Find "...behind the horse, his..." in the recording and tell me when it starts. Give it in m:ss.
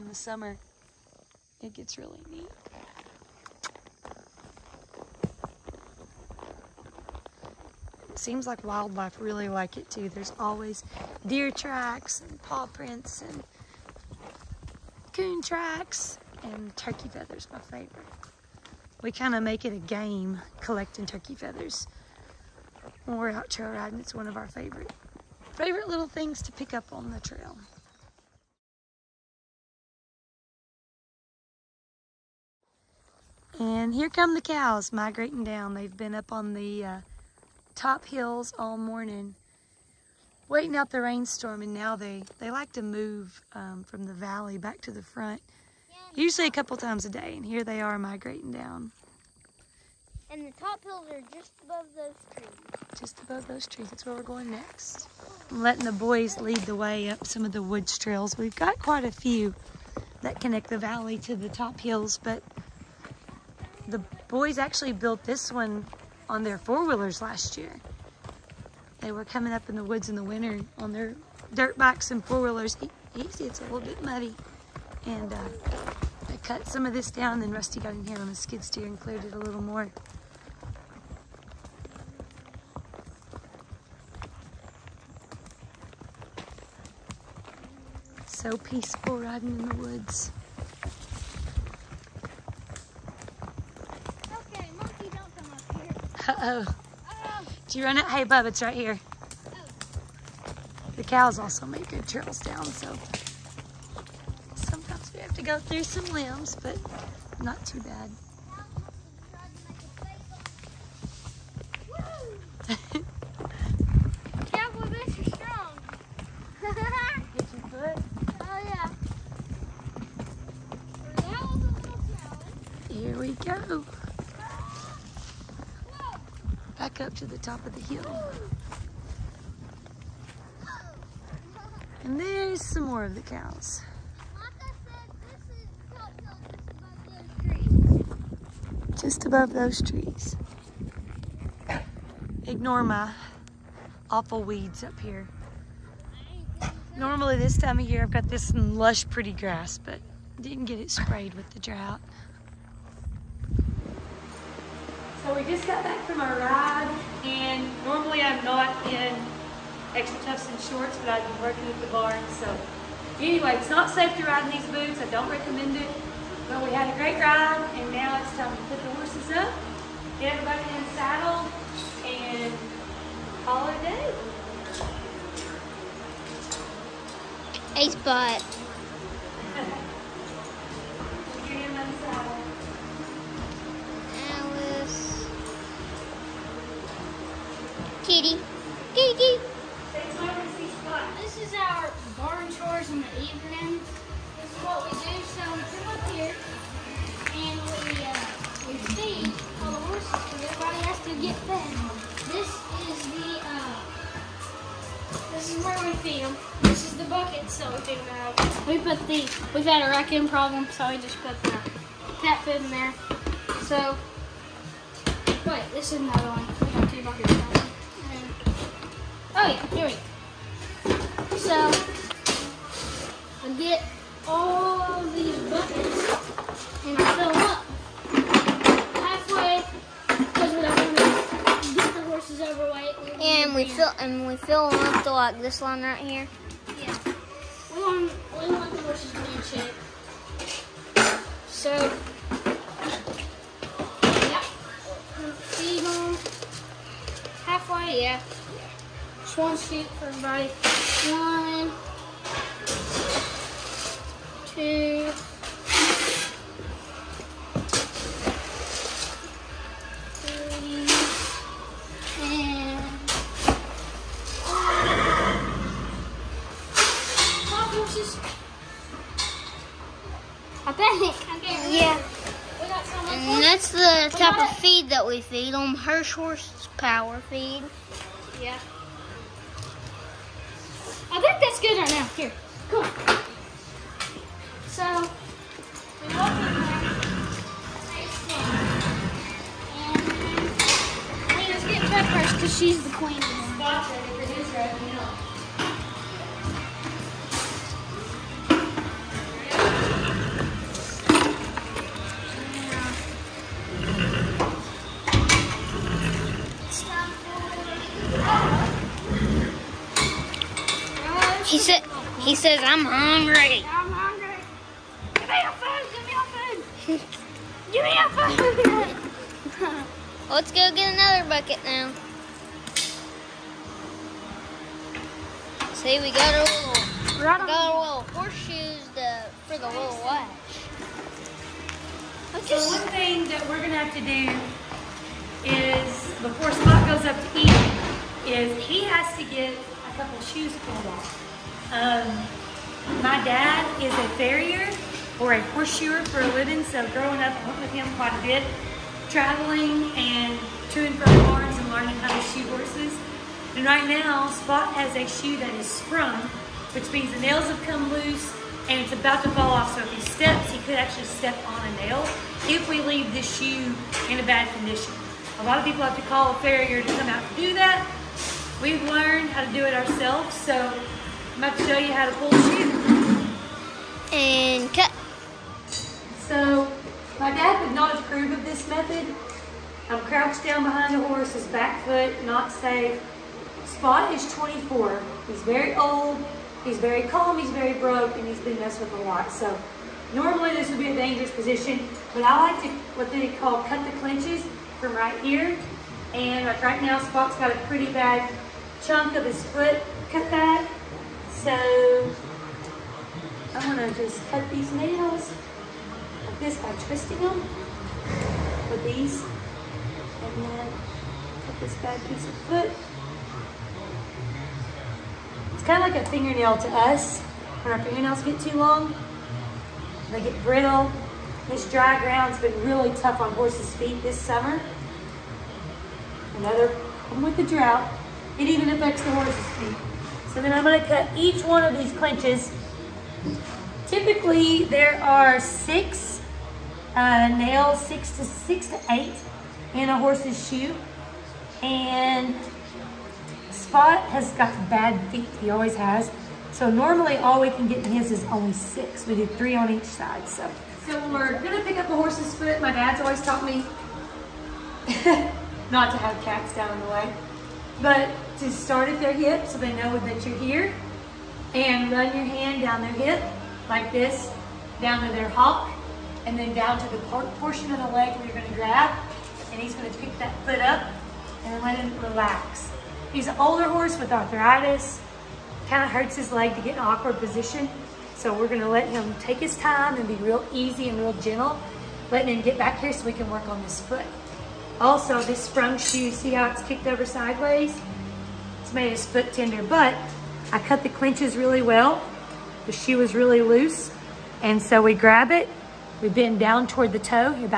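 6:20.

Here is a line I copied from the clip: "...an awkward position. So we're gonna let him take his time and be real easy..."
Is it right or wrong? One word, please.
right.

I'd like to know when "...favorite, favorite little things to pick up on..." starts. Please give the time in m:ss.
0:24.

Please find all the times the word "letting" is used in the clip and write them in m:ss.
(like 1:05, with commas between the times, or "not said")
0:55, 8:02.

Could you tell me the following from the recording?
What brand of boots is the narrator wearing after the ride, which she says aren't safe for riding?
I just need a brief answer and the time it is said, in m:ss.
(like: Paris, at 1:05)
XtraTufs, at 2:39.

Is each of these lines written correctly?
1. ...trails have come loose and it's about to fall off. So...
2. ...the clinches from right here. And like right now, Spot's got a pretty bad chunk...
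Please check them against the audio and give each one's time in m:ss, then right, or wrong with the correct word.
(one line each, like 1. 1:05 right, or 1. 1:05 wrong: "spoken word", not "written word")
1. 5:57 wrong: "nails", not "trails"
2. 6:33 right.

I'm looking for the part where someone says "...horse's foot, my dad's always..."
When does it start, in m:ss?
7:31.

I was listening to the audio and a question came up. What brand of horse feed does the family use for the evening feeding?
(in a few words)
Hirsch horse power feed.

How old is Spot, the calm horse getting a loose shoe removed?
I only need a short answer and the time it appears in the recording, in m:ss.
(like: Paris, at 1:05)
24, at 6:24.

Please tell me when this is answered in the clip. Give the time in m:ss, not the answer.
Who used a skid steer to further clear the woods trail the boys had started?
1:17.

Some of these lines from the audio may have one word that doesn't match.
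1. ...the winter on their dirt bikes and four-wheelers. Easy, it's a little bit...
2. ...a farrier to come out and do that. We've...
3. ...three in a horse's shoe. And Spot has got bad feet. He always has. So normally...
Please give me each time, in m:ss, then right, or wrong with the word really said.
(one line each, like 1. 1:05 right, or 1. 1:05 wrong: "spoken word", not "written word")
1. 1:10 right
2. 6:06 right
3. 7:18 wrong: "eight", not "three".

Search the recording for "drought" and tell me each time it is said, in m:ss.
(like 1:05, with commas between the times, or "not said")
2:31, 7:07.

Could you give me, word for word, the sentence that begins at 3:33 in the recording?
So, wait, this is another one.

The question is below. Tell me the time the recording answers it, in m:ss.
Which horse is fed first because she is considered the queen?
4:51.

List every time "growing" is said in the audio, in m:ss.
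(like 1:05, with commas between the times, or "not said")
5:46.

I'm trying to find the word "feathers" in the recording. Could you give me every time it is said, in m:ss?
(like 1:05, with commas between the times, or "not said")
0:17, 0:21.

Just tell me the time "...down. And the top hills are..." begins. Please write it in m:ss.
0:48.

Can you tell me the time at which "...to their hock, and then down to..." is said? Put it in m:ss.
7:45.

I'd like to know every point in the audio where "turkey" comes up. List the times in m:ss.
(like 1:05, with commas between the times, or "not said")
0:16, 0:21.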